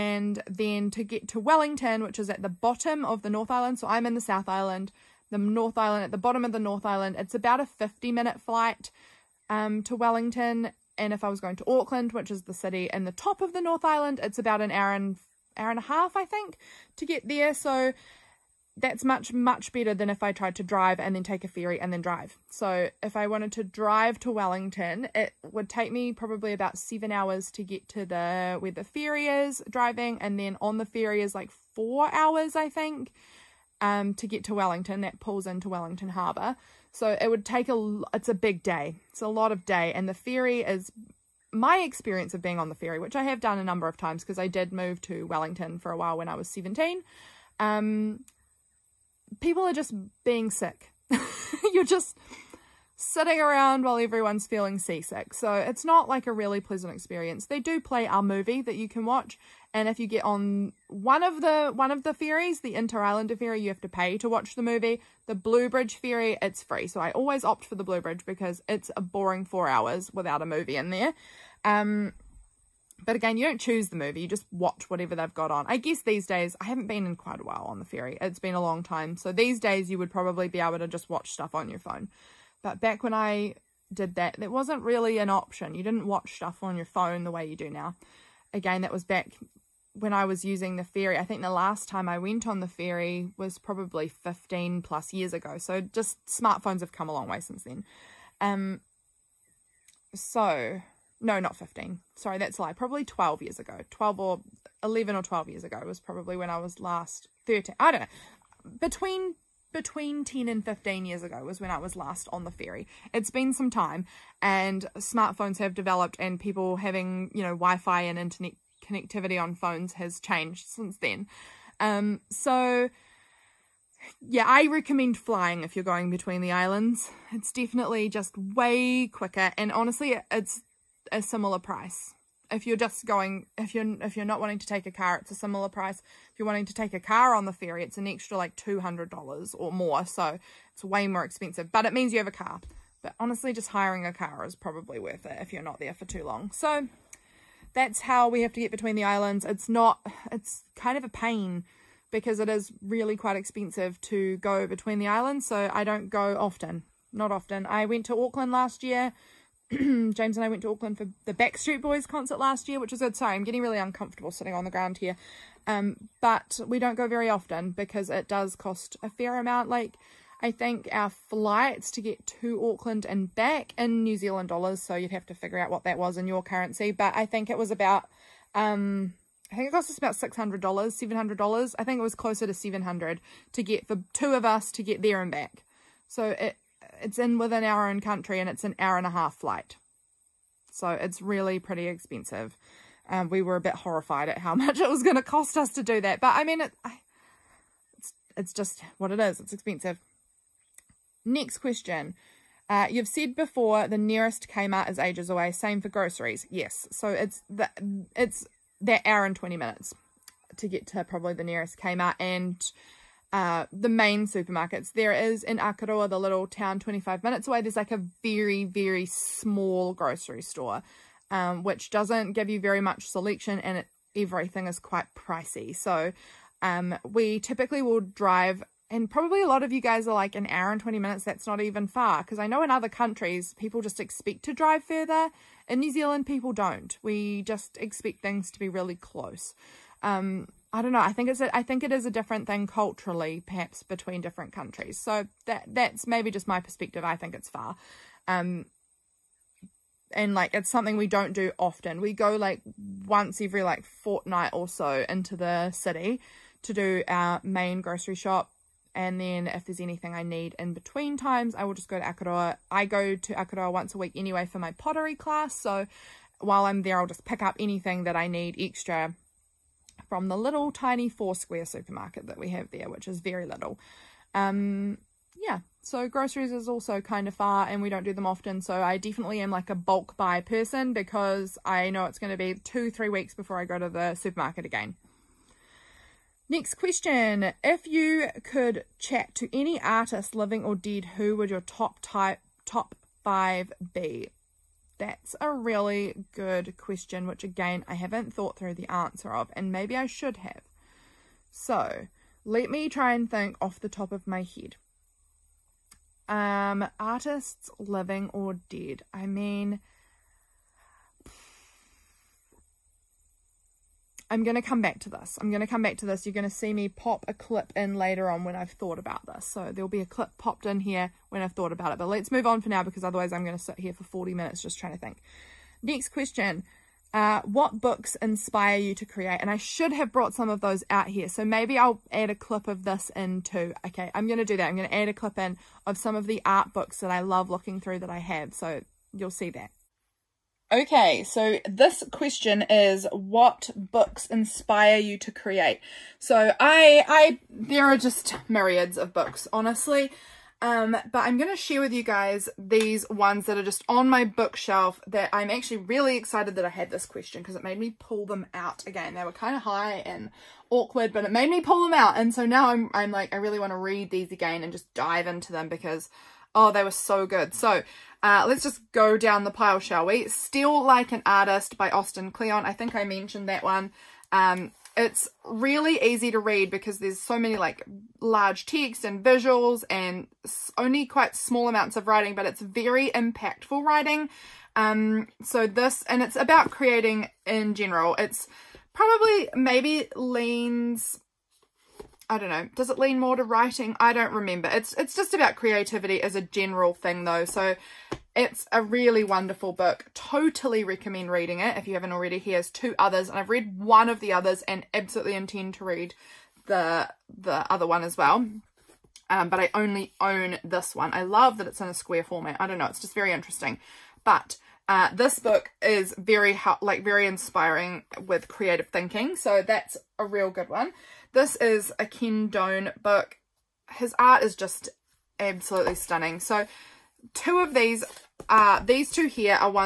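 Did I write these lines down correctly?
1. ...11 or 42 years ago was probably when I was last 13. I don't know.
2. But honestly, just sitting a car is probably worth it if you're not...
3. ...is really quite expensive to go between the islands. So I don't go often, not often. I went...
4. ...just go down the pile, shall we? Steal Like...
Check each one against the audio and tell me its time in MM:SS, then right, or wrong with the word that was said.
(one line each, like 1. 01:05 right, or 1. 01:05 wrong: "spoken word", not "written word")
1. 01:44 wrong: "12", not "42"
2. 02:23 wrong: "hiring", not "sitting"
3. 02:32 right
4. 06:08 right.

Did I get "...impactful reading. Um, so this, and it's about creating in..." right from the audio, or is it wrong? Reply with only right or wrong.
wrong.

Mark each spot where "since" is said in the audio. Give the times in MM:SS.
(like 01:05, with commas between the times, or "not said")
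01:37, 02:00.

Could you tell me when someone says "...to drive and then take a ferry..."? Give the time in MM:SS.
00:20.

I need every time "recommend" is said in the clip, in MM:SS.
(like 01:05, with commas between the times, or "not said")
02:04, 06:40.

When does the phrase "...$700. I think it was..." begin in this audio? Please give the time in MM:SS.
03:00.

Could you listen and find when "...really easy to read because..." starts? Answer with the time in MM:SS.
06:15.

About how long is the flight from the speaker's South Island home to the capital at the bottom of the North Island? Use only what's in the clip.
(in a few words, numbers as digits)
50 minutes.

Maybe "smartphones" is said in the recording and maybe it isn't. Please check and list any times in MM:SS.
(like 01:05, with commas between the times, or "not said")
01:36, 01:54.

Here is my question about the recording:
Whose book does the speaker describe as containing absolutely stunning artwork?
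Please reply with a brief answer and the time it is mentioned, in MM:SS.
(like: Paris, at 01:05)
Ken Done, at 07:02.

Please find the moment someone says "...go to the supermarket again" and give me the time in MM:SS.
04:43.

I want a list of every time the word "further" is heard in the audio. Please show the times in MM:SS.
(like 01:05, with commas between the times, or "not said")
03:54.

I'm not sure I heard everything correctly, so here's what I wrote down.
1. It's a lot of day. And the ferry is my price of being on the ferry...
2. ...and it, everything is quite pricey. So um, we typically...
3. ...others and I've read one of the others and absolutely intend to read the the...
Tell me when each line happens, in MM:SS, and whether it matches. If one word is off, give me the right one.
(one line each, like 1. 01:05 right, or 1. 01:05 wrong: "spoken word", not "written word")
1. 00:39 wrong: "experience", not "price"
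2. 03:43 right
3. 06:42 right.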